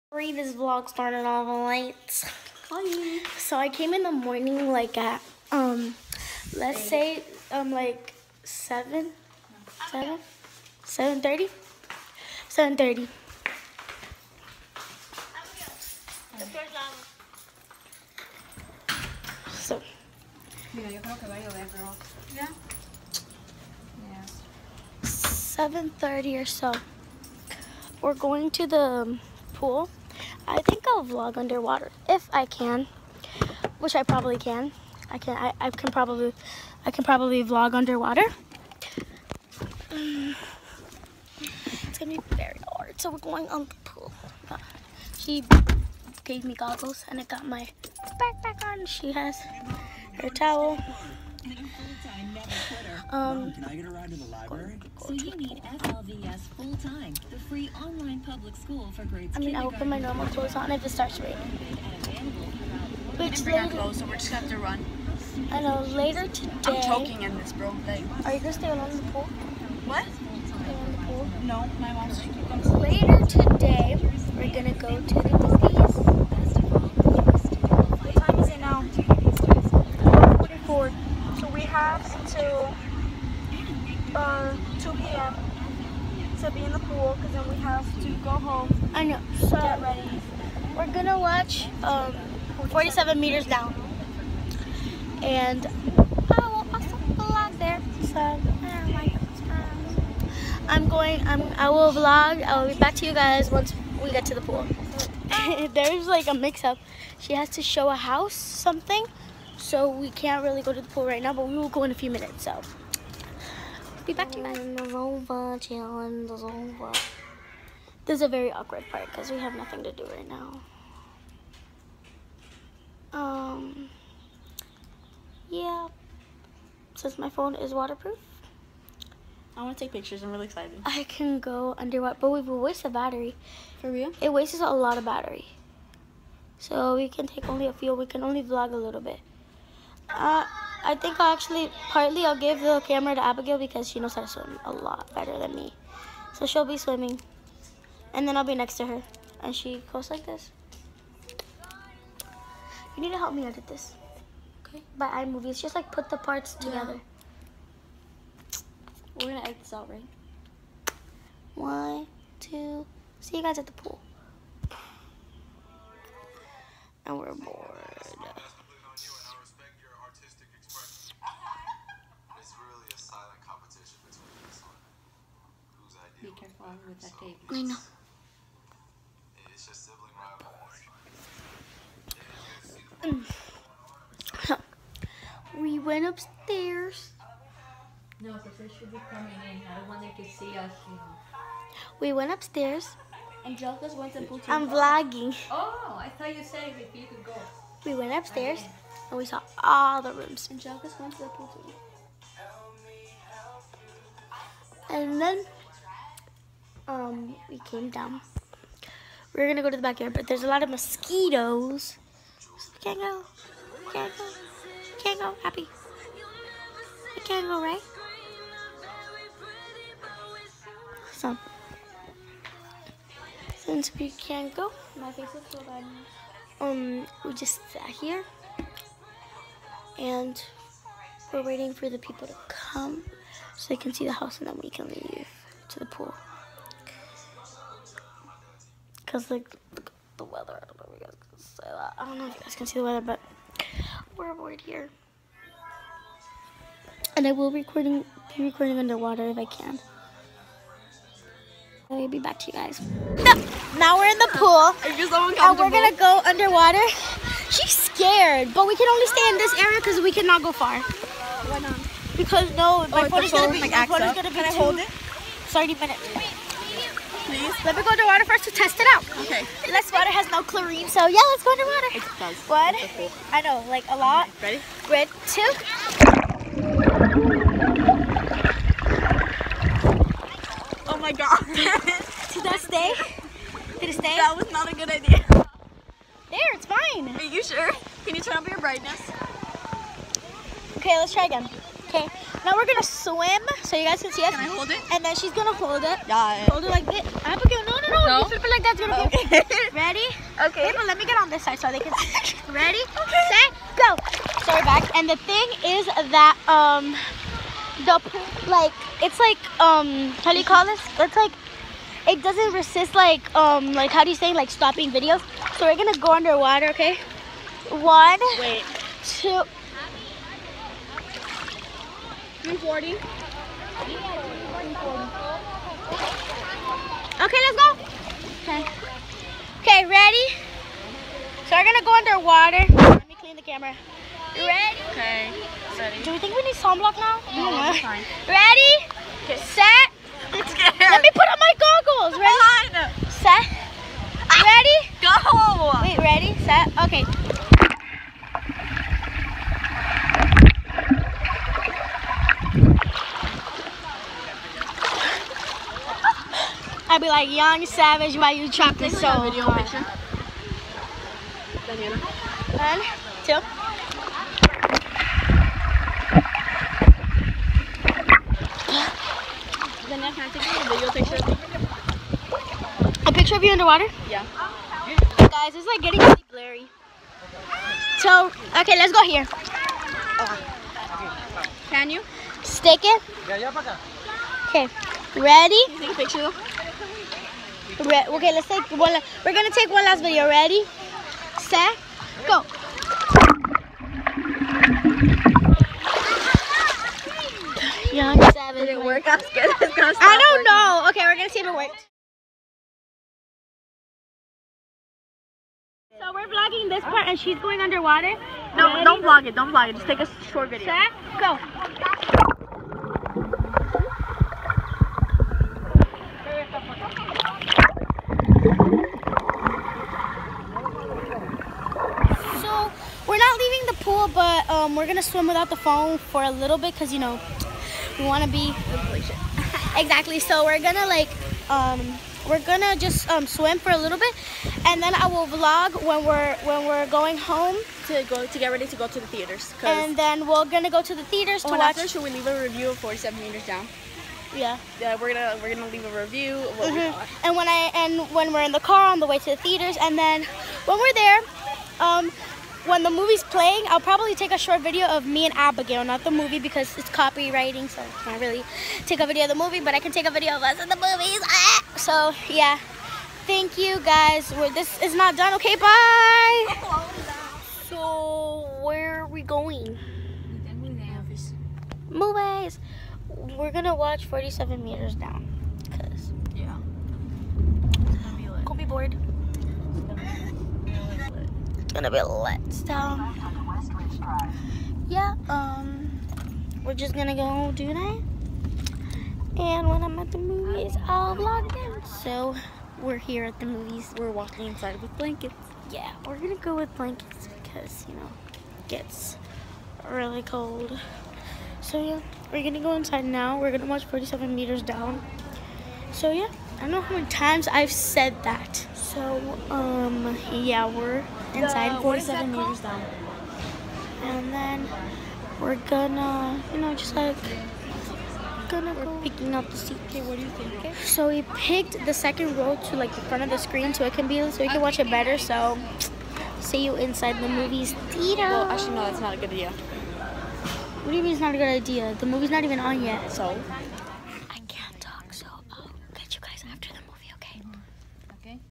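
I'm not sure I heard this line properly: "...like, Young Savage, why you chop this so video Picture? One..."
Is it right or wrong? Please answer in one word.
right.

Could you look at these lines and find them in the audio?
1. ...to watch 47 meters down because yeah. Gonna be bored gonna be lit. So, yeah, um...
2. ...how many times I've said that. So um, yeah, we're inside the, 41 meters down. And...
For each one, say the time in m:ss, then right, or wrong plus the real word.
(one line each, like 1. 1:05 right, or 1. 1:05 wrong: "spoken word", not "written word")
1. 7:53 right
2. 8:26 wrong: "47", not "41".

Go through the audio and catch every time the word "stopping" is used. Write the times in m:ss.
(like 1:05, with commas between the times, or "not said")
5:14.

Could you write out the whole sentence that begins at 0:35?
I can I, I can probably I can probably vlog underwater.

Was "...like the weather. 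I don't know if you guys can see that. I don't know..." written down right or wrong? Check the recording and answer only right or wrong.
right.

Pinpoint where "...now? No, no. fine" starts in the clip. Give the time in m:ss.
5:36.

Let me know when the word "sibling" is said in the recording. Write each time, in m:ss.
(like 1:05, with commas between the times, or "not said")
2:59.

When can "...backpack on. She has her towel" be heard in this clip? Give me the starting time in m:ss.
0:48.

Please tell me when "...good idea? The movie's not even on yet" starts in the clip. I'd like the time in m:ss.
8:51.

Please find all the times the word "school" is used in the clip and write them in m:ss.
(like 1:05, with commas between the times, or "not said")
0:58.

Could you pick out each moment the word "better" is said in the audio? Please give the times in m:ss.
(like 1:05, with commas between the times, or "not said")
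2:25, 8:44.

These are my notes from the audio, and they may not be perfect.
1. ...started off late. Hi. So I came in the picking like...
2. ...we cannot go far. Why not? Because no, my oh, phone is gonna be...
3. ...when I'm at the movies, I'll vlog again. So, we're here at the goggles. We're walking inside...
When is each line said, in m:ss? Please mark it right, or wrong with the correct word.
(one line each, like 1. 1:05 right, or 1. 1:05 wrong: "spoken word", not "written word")
1. 0:00 wrong: "morning", not "picking"
2. 4:20 right
3. 8:09 wrong: "movies", not "goggles".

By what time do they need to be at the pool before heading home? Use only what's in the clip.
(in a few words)
2 p.m.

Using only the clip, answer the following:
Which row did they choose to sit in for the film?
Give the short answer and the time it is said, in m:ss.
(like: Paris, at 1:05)
second row, at 8:41.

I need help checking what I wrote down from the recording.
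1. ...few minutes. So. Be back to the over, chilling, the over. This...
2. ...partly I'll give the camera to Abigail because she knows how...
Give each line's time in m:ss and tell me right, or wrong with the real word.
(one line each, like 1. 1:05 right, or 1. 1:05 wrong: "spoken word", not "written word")
1. 1:51 right
2. 2:21 right.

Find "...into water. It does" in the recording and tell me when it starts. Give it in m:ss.
4:31.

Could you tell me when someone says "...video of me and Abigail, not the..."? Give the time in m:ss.
7:34.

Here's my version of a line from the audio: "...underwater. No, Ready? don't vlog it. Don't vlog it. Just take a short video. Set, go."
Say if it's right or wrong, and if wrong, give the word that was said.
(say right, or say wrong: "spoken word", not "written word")
right.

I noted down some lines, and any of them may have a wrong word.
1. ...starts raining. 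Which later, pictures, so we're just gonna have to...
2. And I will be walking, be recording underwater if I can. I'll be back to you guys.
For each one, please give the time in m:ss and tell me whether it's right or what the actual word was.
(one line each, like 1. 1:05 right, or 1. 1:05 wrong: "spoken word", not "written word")
1. 1:00 wrong: "clothes", not "pictures"
2. 4:07 wrong: "recording", not "walking".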